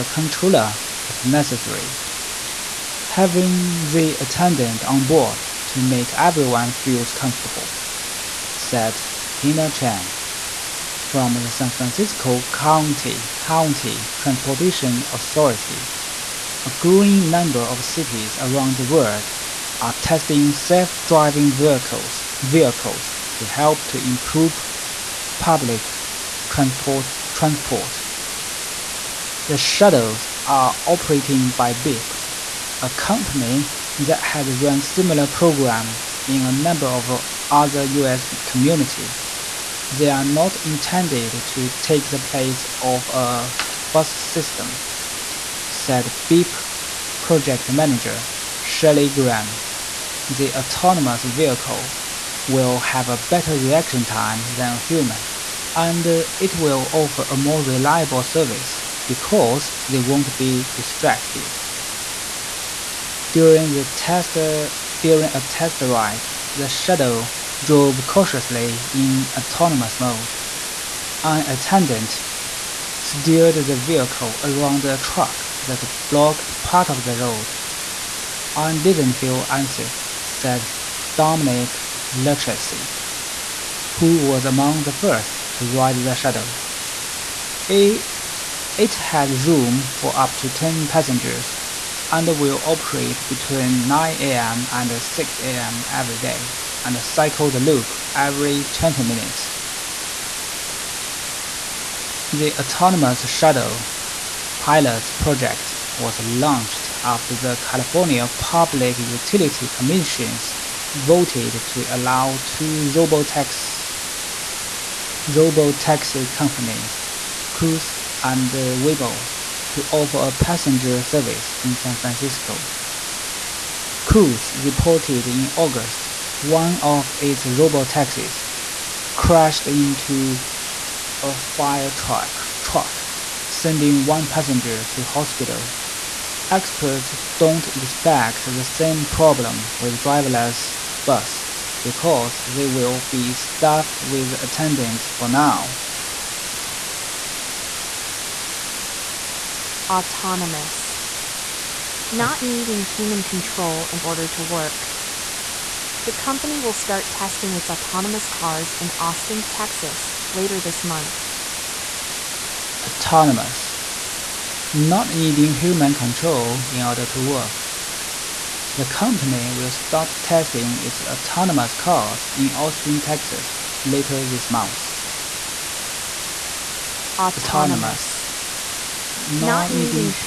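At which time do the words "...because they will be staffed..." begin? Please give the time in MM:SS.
02:21.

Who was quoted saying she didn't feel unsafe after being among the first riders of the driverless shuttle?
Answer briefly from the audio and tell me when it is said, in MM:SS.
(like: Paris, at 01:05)
Dominic Lucchesi, at 01:21.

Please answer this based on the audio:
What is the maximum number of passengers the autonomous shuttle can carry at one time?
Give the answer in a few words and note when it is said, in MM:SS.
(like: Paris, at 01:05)
10, at 01:30.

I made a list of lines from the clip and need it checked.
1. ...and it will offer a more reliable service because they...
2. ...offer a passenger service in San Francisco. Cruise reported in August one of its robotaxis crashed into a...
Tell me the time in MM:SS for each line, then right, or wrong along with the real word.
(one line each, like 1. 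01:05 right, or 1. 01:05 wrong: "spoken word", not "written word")
1. 00:55 right
2. 01:59 right.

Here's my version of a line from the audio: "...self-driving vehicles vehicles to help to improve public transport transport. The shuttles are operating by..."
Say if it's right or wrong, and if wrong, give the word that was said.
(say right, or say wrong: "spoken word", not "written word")
right.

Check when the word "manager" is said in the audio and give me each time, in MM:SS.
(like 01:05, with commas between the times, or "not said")
00:47.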